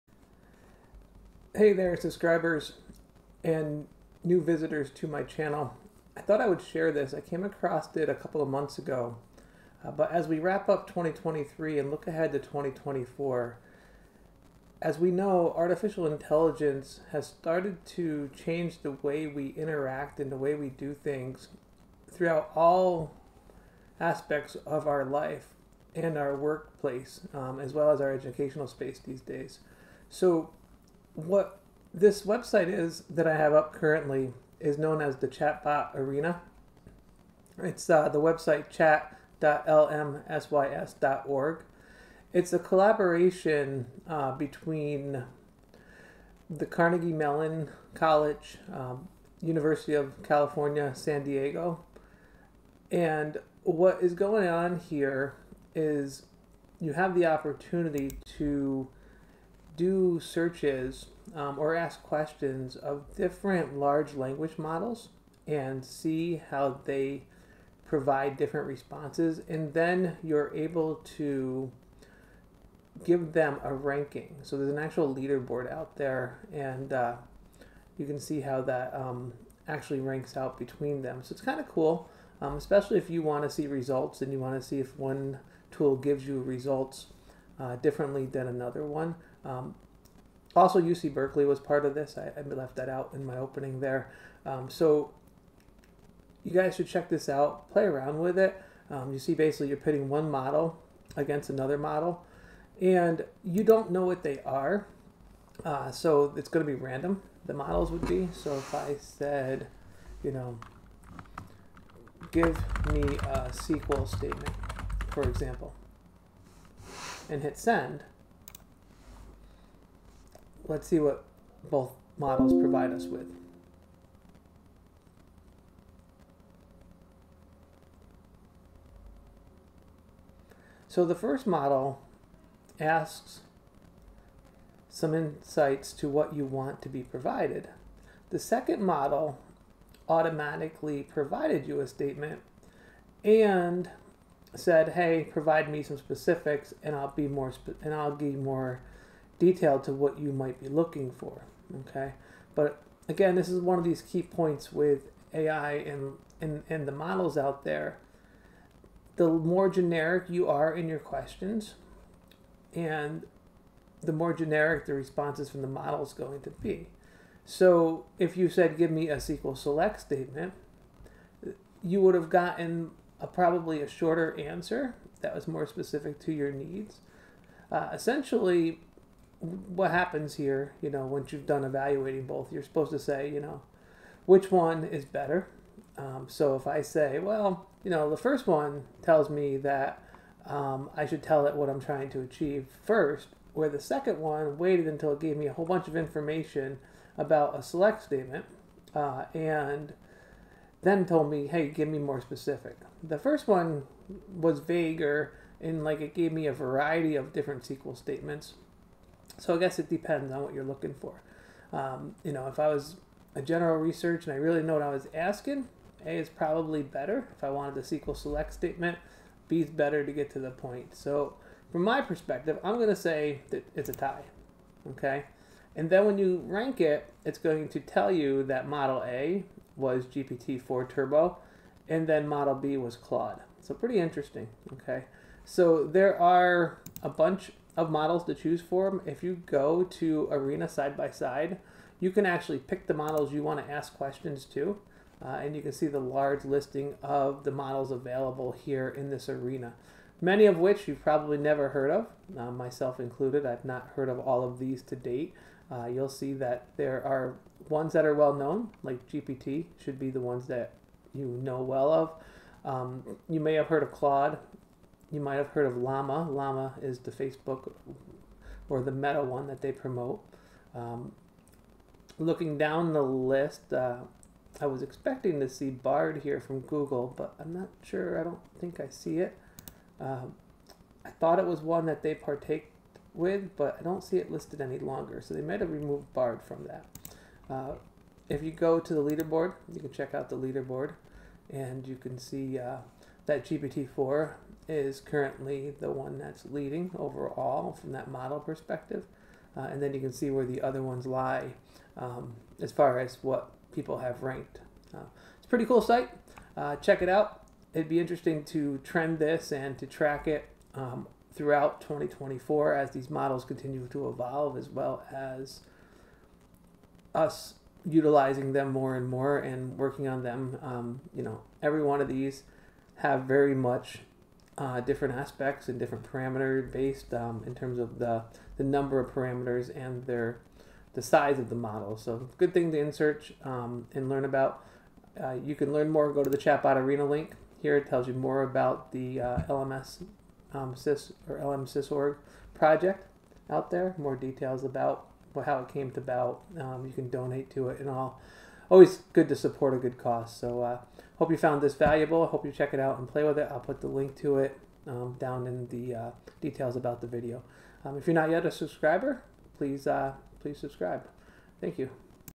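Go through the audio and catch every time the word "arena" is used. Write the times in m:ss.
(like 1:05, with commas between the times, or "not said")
0:35, 4:00, 4:09, 5:36.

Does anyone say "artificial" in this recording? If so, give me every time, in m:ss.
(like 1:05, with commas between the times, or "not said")
0:15.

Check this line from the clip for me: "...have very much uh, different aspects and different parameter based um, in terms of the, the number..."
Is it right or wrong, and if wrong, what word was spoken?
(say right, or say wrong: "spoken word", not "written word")
right.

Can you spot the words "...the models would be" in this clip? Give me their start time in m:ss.
1:47.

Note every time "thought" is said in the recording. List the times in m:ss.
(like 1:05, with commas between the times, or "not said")
0:06, 4:41.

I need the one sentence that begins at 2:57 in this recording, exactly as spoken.
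Uh, essentially, what happens here, you know, once you've done evaluating both, you're supposed to say, you know, which one is better.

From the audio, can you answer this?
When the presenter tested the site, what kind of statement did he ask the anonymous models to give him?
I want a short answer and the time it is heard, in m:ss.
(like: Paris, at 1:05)
SQL statement, at 1:53.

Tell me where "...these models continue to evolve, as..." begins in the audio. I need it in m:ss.
5:12.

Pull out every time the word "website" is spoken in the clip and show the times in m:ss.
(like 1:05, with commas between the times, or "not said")
0:32, 0:38.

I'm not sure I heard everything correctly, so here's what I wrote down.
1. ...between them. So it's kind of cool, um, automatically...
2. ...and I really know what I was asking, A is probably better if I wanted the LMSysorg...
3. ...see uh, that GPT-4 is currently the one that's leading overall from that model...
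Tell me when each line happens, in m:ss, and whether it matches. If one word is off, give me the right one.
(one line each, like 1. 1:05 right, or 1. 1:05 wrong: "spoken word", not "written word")
1. 1:20 wrong: "especially", not "automatically"
2. 3:34 wrong: "SQL", not "LMSysorg"
3. 4:52 right.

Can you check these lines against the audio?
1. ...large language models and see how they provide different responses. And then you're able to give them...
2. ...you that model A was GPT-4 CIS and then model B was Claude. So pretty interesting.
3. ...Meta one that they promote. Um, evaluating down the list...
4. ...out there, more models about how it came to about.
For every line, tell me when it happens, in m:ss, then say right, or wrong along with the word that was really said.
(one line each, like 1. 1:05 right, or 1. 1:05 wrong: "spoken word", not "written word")
1. 1:03 right
2. 3:48 wrong: "Turbo", not "CIS"
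3. 4:28 wrong: "looking", not "evaluating"
4. 5:43 wrong: "details", not "models".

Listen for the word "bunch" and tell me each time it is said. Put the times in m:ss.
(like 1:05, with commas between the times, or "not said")
3:15, 3:57.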